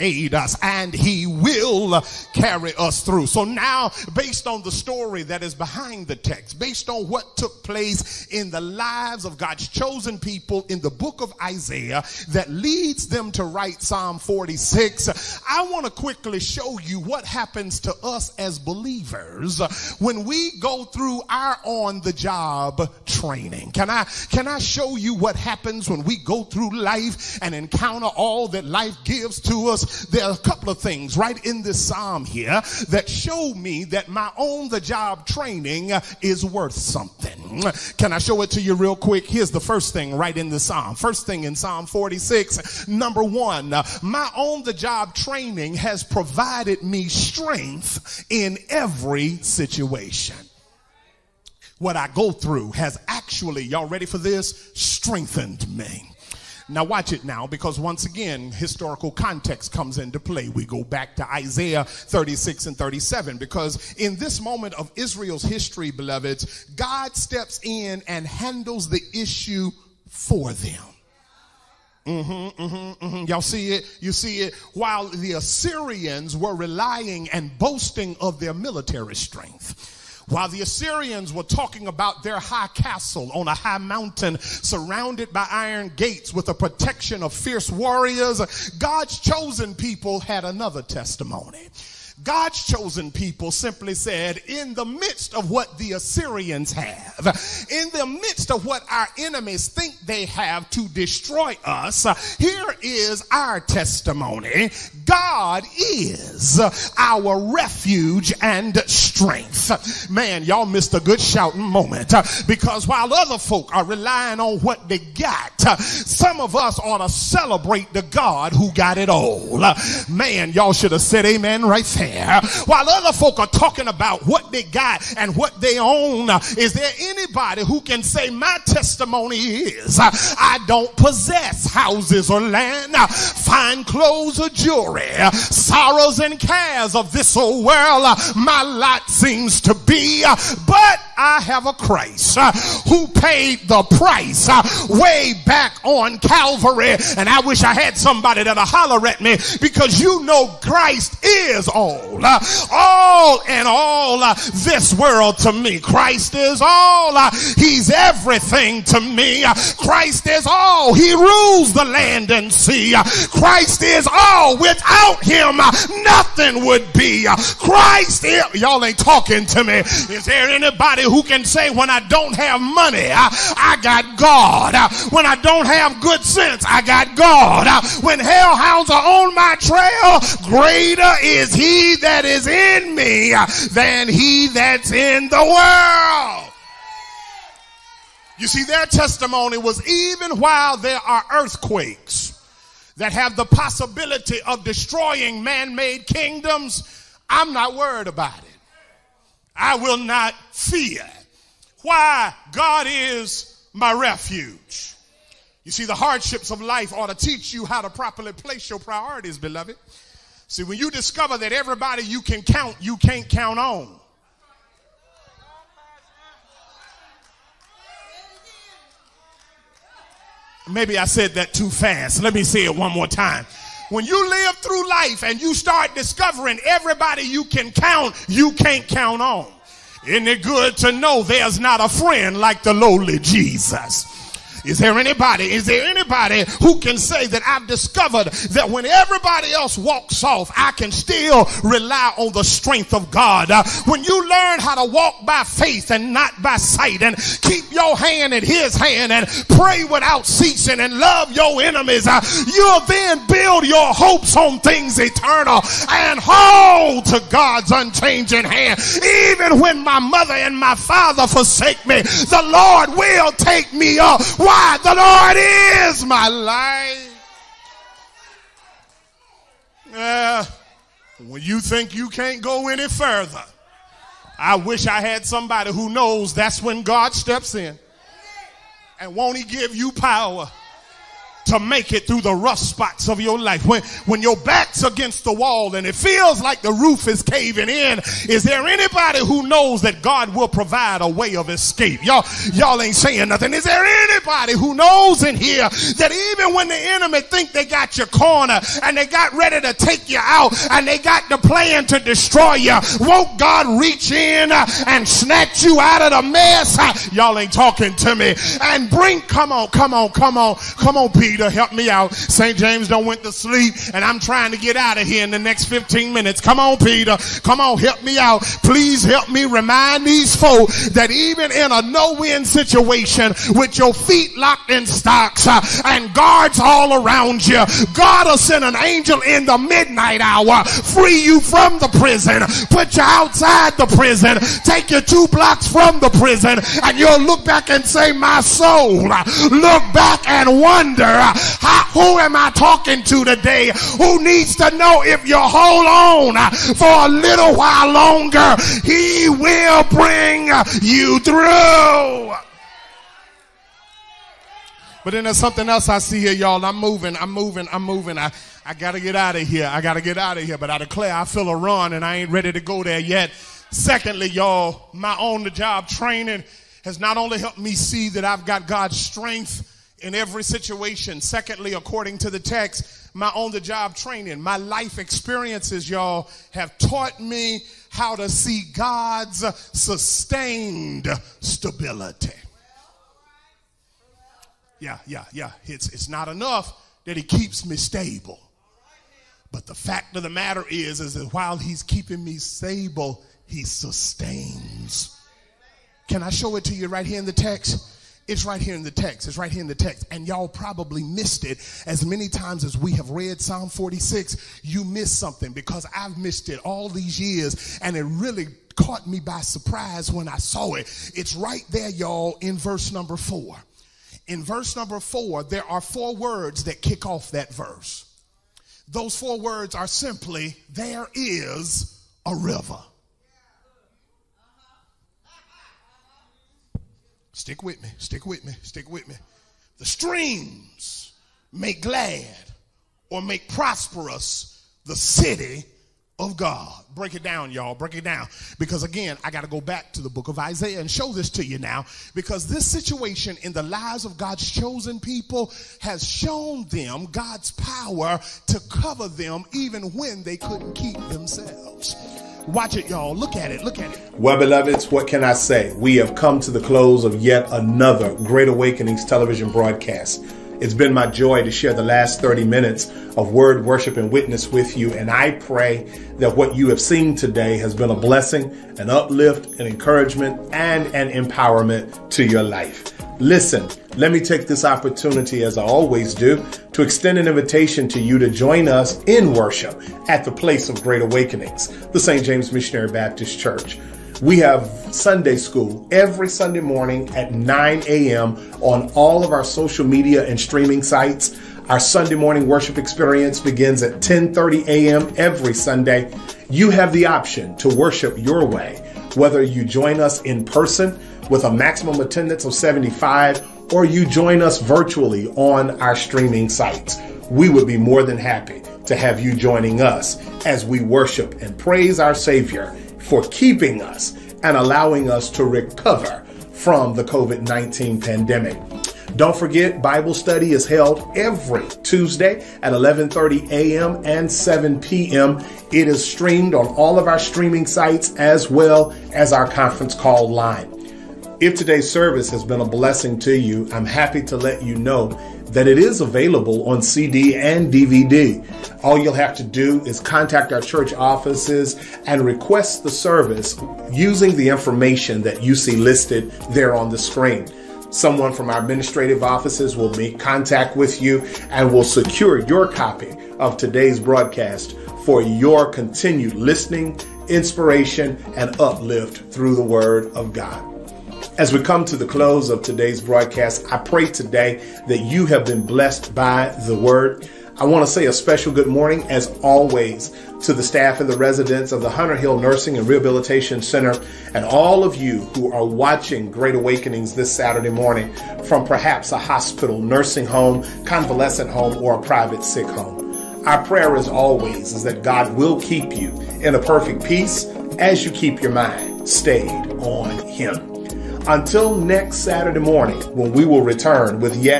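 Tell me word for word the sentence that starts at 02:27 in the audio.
And I wish I had somebody that'll holler at me because you know Christ is on all.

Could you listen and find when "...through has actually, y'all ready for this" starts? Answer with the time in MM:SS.
00:52.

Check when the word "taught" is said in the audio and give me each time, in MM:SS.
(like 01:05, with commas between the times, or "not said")
06:16.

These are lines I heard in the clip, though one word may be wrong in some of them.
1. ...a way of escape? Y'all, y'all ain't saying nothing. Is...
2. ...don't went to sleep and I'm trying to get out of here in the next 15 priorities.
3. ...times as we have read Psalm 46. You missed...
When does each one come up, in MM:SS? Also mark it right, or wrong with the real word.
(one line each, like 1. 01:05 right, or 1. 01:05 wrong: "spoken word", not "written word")
1. 04:51 right
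2. 05:12 wrong: "minutes", not "priorities"
3. 06:42 right.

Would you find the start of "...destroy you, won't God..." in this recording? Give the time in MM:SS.
05:01.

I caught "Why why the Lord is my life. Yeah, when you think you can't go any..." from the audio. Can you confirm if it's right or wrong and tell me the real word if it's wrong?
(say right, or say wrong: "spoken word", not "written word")
right.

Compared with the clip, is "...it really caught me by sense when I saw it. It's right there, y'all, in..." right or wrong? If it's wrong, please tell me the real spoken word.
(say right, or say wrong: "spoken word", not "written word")
wrong: "surprise", not "sense".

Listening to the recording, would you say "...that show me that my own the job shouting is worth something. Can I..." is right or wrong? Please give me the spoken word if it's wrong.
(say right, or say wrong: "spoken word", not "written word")
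wrong: "training", not "shouting".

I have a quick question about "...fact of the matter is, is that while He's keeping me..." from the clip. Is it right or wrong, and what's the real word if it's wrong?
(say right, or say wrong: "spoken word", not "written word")
right.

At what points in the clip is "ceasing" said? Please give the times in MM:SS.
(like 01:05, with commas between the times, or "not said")
04:10.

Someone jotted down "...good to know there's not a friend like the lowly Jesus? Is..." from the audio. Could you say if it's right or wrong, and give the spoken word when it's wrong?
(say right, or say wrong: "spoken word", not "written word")
right.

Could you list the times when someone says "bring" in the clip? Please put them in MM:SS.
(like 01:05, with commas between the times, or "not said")
05:08, 05:49.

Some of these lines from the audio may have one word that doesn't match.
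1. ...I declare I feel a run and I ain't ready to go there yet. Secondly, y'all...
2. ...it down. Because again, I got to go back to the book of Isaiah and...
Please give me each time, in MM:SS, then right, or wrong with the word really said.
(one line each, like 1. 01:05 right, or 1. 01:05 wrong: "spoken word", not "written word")
1. 06:00 right
2. 07:17 right.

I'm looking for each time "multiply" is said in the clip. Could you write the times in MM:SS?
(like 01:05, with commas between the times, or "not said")
not said.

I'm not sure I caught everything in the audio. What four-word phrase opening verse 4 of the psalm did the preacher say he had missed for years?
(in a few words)
There is a river.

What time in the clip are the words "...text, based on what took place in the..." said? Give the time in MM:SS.
00:06.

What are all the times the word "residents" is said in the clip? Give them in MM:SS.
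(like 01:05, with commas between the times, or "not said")
09:31.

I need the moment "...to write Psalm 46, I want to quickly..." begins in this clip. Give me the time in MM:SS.
00:13.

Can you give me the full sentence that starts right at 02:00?
Man, y'all should have said amen right there there while other folk are talking about what they got and what they own.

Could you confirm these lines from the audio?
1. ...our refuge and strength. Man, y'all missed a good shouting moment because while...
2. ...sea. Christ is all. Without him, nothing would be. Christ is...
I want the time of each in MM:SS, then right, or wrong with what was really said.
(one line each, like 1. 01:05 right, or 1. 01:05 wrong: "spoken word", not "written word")
1. 01:46 right
2. 02:42 right.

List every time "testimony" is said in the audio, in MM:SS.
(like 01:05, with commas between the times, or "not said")
01:30, 01:43, 02:08, 03:08.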